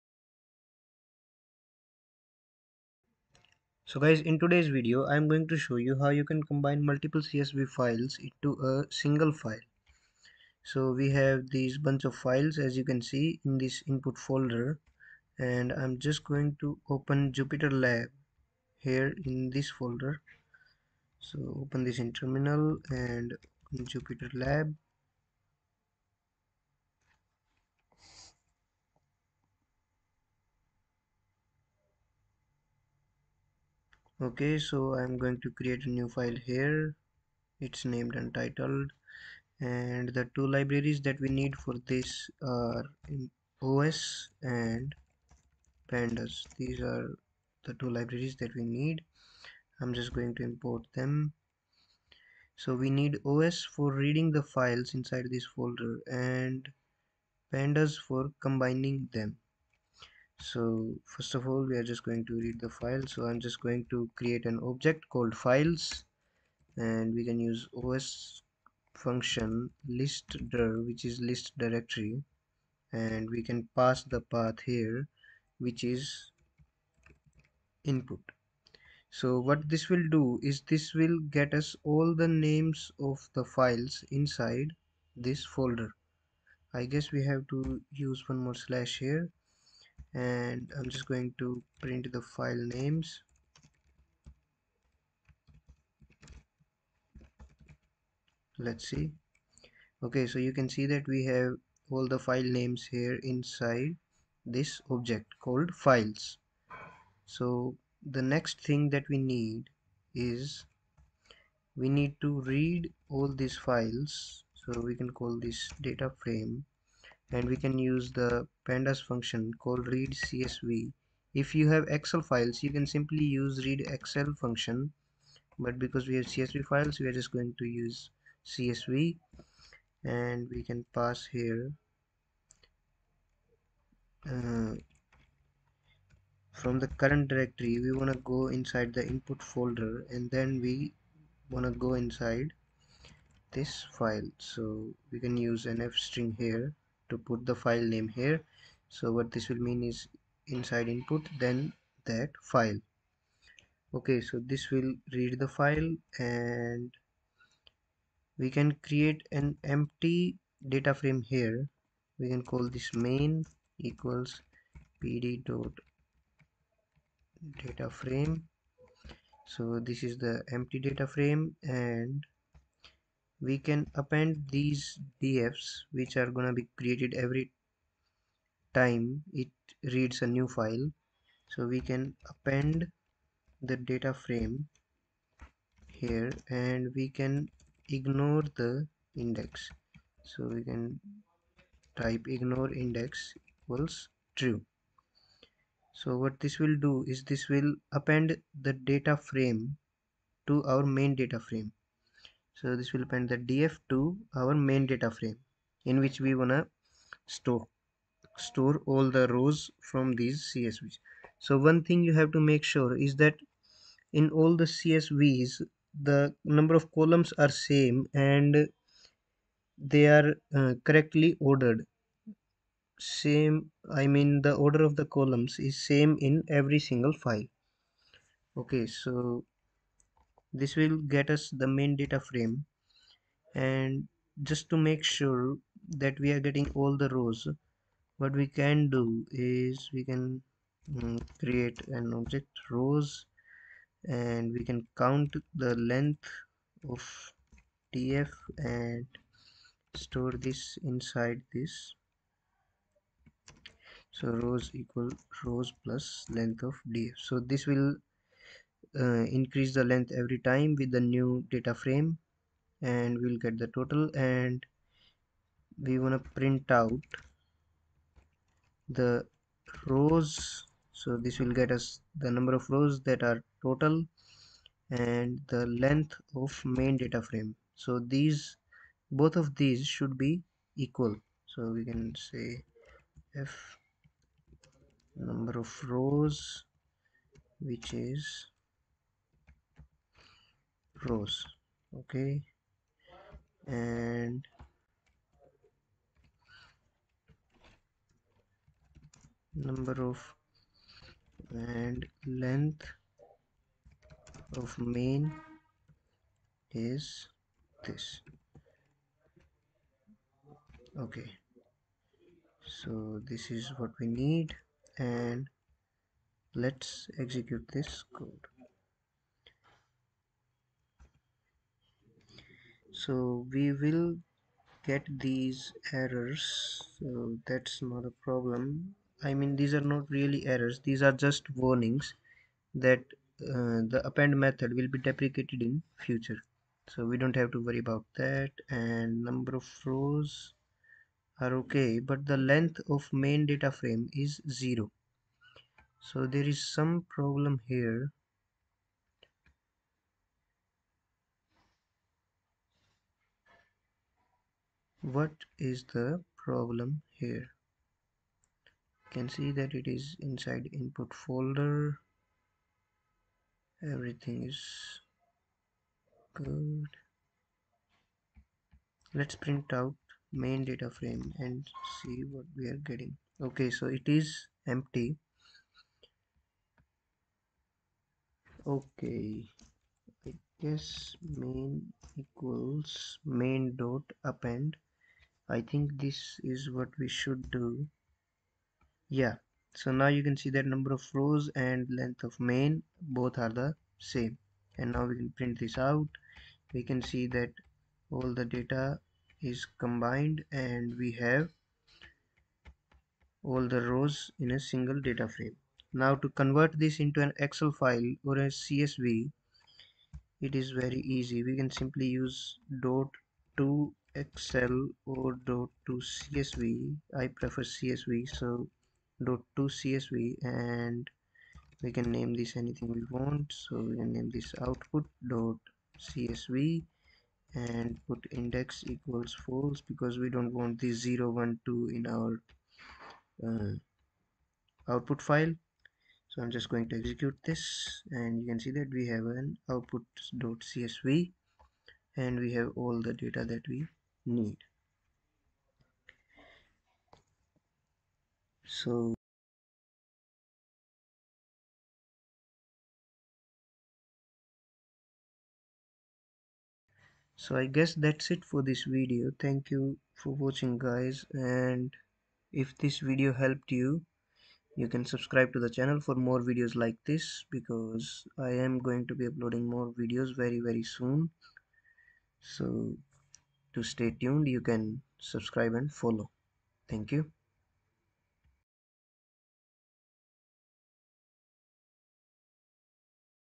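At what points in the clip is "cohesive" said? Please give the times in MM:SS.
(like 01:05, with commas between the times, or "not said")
not said.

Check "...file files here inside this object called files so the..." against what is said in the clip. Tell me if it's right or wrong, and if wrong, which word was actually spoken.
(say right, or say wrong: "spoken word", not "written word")
wrong: "names", not "files".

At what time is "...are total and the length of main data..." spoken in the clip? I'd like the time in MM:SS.
04:33.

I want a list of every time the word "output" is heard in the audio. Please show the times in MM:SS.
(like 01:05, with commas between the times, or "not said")
07:04, 07:14, 07:19.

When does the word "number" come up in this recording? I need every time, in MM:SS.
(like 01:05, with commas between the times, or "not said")
03:36, 04:32, 04:45, 04:59, 05:39, 06:30.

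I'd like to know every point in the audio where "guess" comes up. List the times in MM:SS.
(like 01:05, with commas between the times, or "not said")
01:26, 06:20, 07:37.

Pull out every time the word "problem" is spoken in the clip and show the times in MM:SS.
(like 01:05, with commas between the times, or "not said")
05:28, 05:47, 05:56.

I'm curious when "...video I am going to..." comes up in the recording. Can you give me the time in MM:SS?
00:04.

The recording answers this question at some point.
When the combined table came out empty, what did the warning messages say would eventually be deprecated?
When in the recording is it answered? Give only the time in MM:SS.
05:34.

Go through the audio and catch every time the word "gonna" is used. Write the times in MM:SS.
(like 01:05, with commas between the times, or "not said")
02:56.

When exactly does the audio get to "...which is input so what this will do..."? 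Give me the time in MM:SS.
01:15.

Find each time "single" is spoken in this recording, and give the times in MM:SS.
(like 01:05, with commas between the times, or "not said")
00:08, 03:46, 06:44.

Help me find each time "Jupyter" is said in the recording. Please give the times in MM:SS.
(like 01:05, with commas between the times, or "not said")
00:17, 00:23.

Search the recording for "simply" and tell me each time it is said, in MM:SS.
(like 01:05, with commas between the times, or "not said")
02:02, 06:51.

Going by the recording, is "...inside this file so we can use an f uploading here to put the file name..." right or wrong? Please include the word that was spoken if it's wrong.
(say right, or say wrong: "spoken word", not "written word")
wrong: "string", not "uploading".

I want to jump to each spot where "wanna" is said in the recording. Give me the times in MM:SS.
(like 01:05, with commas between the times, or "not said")
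03:26.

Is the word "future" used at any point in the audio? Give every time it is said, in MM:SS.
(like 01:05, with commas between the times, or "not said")
05:36.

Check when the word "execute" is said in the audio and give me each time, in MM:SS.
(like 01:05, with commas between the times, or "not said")
05:17, 07:16.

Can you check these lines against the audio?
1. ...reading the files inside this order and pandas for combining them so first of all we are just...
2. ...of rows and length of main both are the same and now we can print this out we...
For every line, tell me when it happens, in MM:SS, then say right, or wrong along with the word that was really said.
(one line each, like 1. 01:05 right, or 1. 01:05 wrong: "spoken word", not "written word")
1. 00:53 wrong: "folder", not "order"
2. 06:30 right.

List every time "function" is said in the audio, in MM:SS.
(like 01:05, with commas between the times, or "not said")
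01:09, 01:59, 02:04.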